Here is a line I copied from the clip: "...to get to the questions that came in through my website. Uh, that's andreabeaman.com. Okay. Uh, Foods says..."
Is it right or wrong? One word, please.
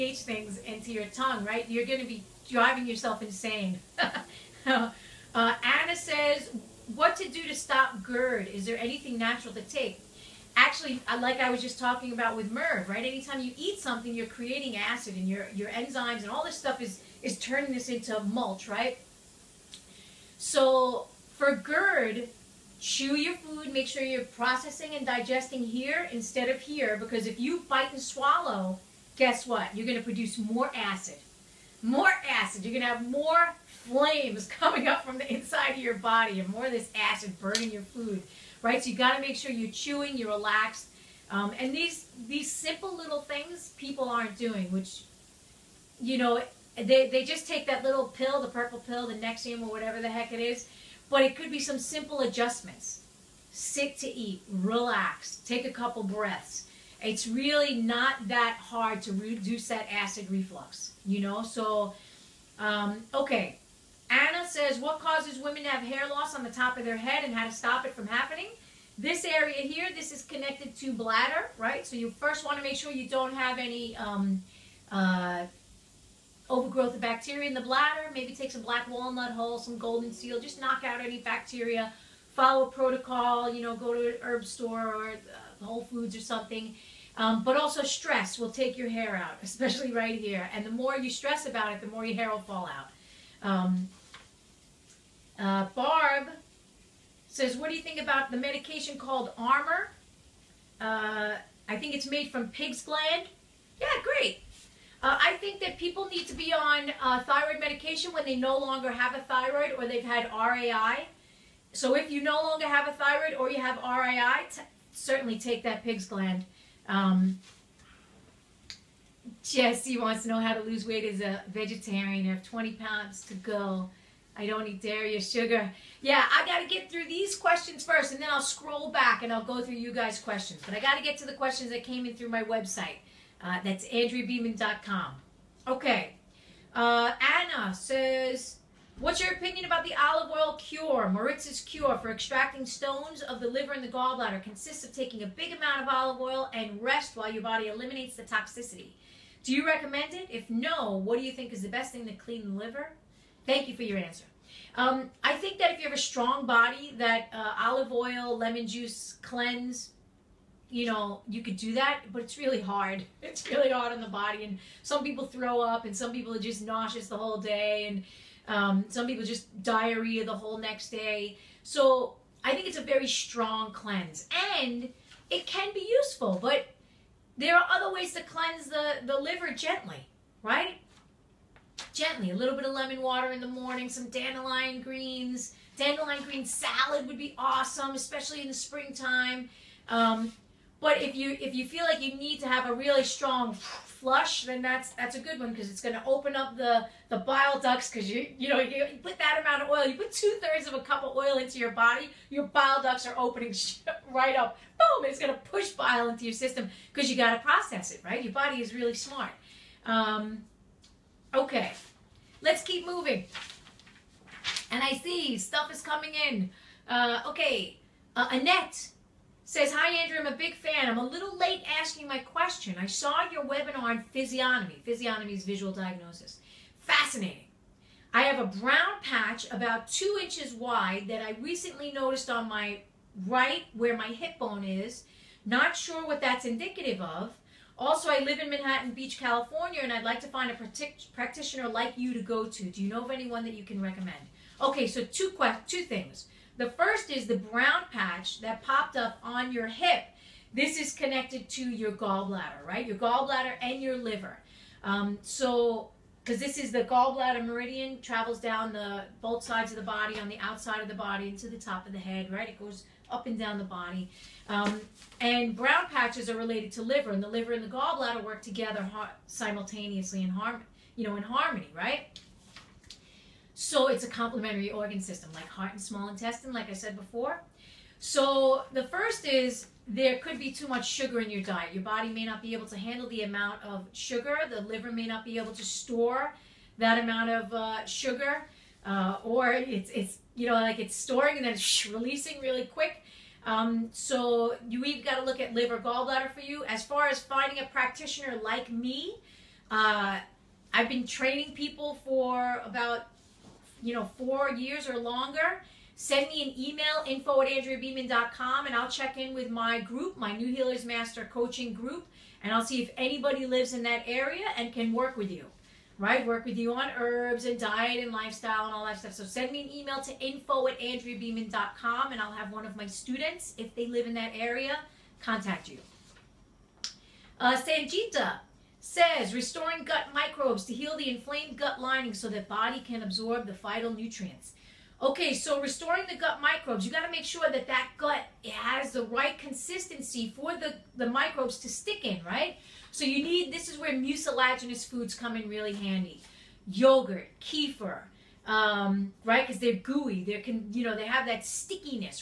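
wrong.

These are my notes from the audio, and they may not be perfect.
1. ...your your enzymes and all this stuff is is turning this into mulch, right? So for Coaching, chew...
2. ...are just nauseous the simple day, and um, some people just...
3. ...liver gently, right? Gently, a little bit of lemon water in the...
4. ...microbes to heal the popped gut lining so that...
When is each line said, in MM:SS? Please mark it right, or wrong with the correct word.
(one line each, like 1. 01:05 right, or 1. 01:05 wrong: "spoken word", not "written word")
1. 00:15 wrong: "GERD", not "Coaching"
2. 02:46 wrong: "whole", not "simple"
3. 02:59 right
4. 05:30 wrong: "inflamed", not "popped".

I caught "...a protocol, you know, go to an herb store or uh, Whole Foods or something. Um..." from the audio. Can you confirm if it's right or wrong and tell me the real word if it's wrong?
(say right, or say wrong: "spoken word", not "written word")
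right.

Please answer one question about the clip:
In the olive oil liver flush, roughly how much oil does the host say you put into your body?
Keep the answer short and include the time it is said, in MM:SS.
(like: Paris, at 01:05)
two thirds of a cup, at 03:20.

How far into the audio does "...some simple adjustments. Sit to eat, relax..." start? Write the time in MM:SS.
00:51.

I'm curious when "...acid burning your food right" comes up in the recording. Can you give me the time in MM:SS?
00:36.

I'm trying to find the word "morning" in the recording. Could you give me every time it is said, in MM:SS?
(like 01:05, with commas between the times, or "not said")
03:03.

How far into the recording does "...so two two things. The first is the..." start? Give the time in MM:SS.
04:04.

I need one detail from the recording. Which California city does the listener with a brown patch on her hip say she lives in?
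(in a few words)
Manhattan Beach.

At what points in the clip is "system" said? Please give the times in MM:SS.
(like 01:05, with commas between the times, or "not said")
03:26, 04:34.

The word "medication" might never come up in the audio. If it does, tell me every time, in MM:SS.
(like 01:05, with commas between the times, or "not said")
01:38, 01:47.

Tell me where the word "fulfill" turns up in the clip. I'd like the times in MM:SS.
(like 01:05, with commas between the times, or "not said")
not said.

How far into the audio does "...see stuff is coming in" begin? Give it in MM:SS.
03:35.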